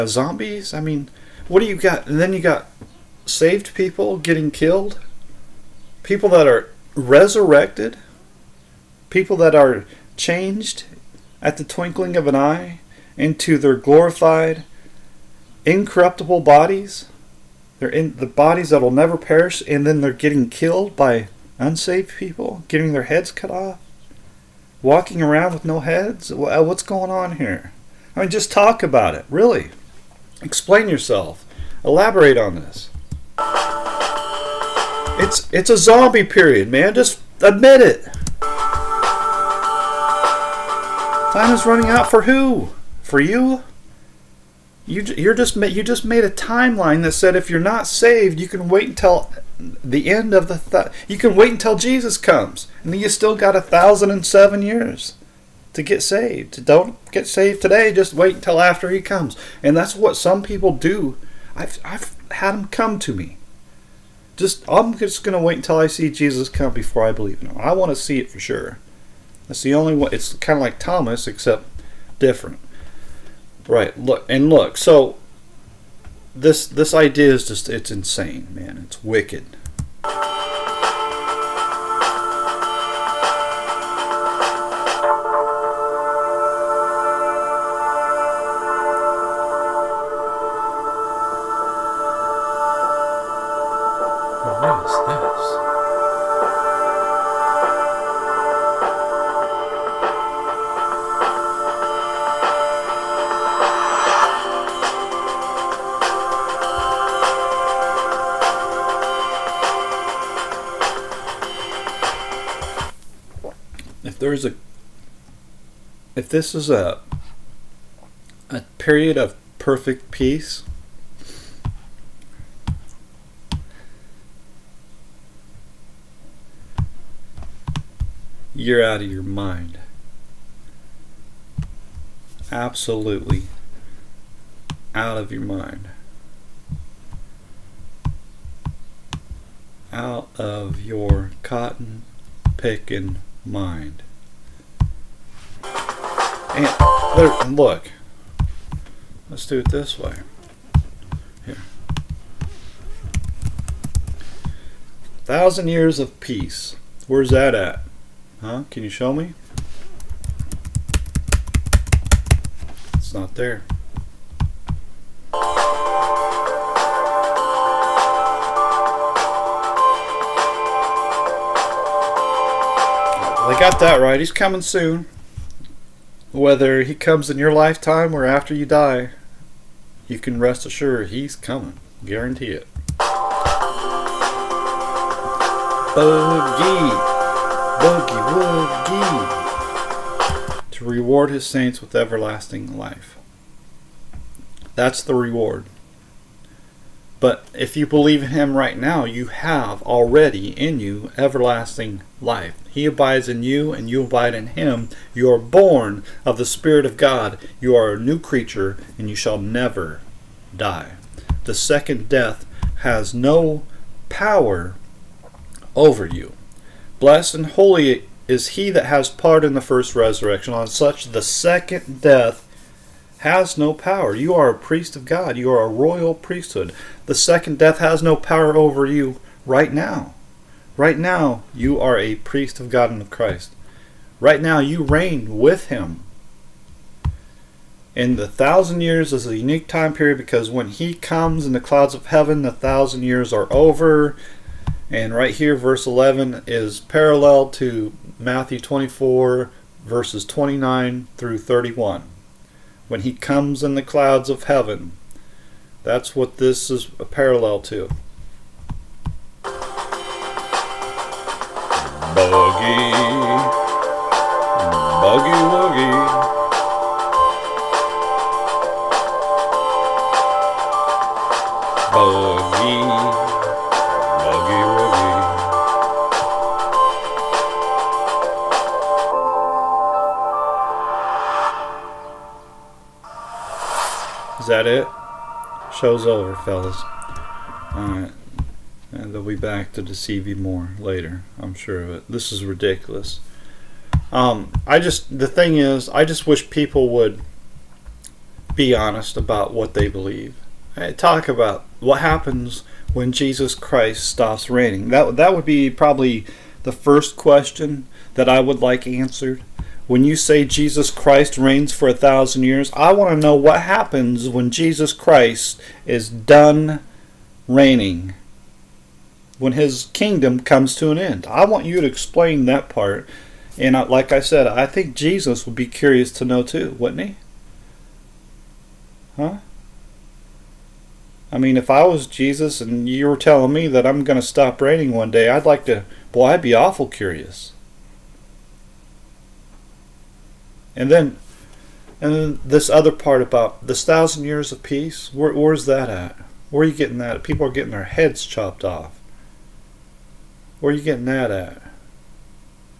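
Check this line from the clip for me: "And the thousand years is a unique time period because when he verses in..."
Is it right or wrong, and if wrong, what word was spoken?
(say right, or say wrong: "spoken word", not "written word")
wrong: "comes", not "verses".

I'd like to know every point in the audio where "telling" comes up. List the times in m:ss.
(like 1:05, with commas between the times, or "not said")
5:33.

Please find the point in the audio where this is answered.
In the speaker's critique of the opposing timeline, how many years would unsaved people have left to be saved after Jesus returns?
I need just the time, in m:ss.
0:53.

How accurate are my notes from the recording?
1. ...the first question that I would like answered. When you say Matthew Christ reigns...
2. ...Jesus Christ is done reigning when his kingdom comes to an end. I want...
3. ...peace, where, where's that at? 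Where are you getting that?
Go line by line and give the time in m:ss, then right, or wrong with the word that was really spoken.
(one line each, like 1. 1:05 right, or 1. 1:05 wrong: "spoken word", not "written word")
1. 5:06 wrong: "Jesus", not "Matthew"
2. 5:14 right
3. 5:44 right.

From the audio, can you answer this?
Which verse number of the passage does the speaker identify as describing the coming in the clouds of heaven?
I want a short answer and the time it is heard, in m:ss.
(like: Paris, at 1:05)
11, at 4:05.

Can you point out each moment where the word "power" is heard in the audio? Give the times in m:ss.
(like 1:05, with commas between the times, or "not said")
3:34, 3:43, 3:48.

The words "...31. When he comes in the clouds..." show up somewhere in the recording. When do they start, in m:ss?
4:11.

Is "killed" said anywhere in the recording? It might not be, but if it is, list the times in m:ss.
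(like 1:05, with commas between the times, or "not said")
0:04, 0:20.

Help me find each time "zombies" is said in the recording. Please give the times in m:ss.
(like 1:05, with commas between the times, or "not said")
0:00, 0:35.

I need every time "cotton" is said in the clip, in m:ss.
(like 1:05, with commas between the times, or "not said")
2:21.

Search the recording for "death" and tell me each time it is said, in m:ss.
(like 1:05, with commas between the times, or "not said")
3:32, 3:42, 3:47.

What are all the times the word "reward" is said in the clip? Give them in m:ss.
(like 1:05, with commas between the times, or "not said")
3:10, 3:15.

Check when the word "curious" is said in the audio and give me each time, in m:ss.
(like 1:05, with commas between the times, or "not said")
5:25, 5:36.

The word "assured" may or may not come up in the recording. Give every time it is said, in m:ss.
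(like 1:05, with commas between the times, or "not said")
3:00.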